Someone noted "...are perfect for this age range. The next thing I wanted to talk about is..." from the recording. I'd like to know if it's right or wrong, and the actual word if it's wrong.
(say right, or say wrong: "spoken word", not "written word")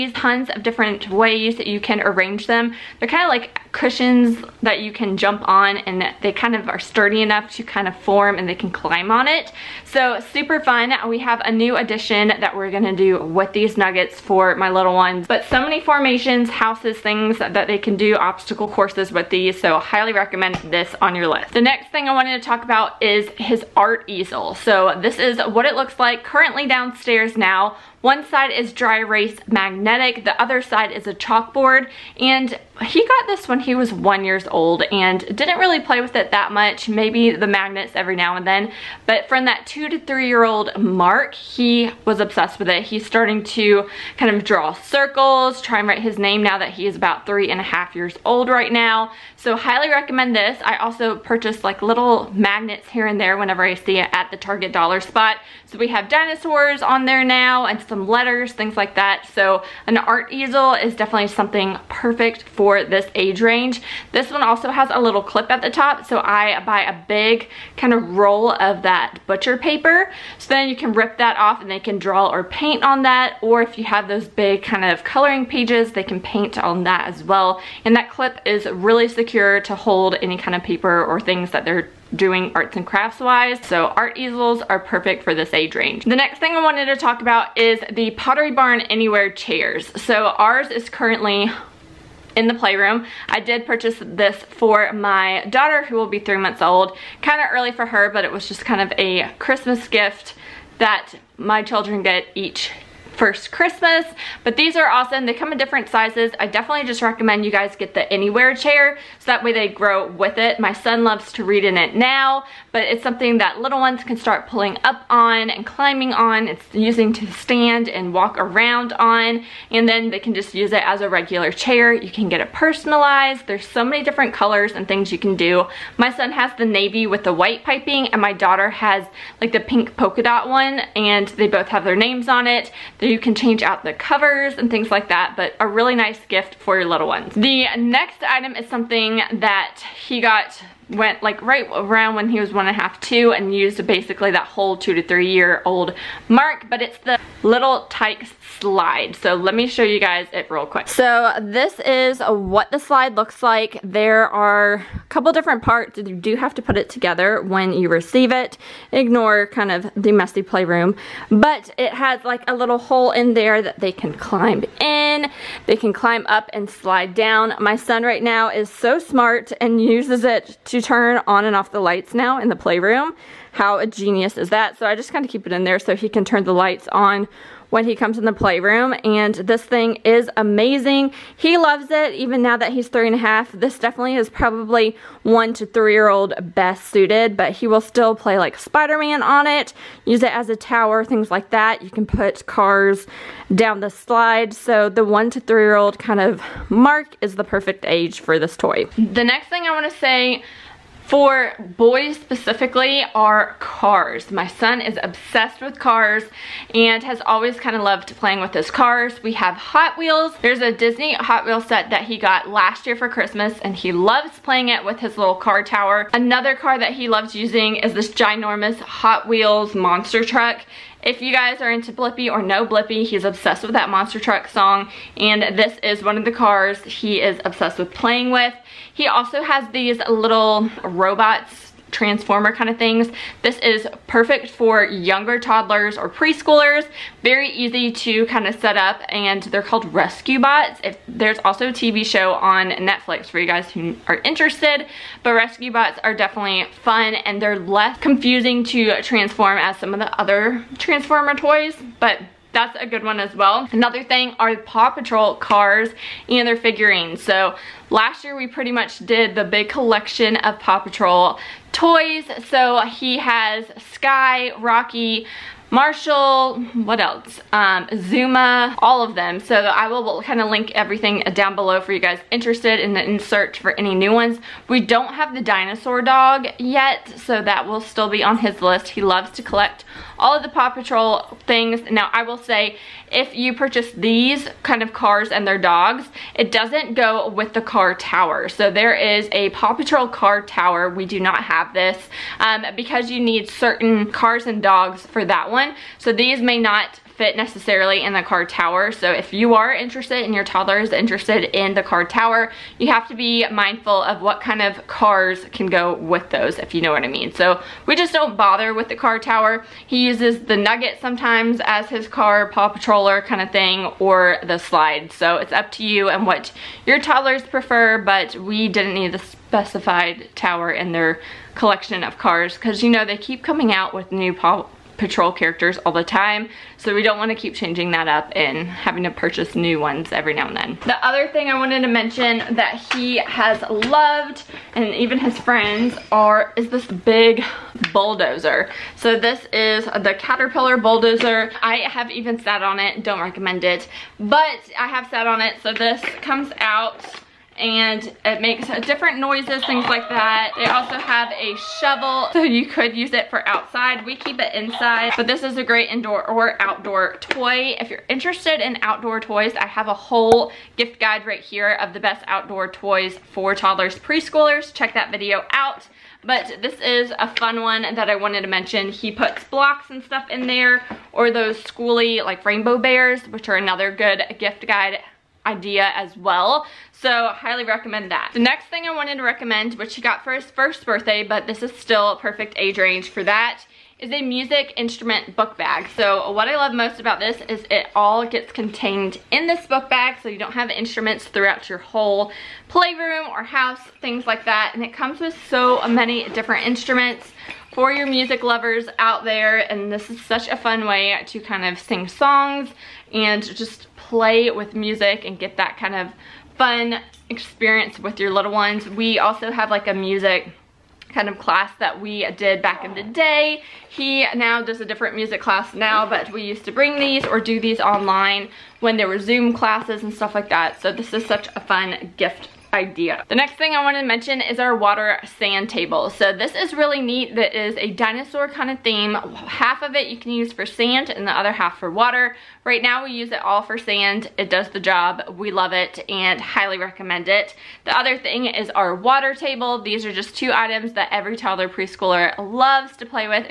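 right.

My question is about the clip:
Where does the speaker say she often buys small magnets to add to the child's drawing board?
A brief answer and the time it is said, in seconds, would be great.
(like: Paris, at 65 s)
Target dollar spot, at 54 s.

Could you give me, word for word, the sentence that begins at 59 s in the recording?
So an art easel is definitely something perfect for this age range.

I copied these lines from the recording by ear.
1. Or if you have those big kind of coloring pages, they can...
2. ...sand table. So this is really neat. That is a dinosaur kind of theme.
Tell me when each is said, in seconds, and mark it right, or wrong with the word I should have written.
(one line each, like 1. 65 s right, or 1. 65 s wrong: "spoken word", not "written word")
1. 73 s right
2. 425 s right.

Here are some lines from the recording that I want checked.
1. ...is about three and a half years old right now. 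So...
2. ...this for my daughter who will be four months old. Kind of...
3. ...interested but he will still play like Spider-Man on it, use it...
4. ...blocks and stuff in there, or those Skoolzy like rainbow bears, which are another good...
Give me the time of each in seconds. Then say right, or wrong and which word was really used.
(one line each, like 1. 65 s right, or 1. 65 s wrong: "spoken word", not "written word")
1. 46 s right
2. 94 s wrong: "three", not "four"
3. 186 s wrong: "suited", not "interested"
4. 369 s right.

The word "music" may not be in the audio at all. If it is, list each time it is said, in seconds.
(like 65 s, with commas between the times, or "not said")
384 s, 398 s, 404 s, 409 s, 415 s.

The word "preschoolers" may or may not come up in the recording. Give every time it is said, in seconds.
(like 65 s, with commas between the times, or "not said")
236 s, 363 s, 441 s.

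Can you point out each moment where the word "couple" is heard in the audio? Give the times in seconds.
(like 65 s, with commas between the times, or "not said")
155 s.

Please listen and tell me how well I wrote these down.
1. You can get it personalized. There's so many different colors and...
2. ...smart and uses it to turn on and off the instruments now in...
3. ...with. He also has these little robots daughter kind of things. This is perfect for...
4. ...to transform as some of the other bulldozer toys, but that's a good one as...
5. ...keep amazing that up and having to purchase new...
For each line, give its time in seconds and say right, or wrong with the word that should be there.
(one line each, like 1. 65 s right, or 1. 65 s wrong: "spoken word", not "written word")
1. 121 s right
2. 168 s wrong: "lights", not "instruments"
3. 228 s wrong: "transformer", not "daughter"
4. 248 s wrong: "transformer", not "bulldozer"
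5. 327 s wrong: "changing", not "amazing".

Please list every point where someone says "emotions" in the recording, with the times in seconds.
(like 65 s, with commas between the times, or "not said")
not said.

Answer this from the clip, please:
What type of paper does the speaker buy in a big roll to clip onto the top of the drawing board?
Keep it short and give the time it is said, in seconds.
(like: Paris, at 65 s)
Butcher paper, at 69 s.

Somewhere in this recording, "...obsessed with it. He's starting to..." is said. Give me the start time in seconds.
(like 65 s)
42 s.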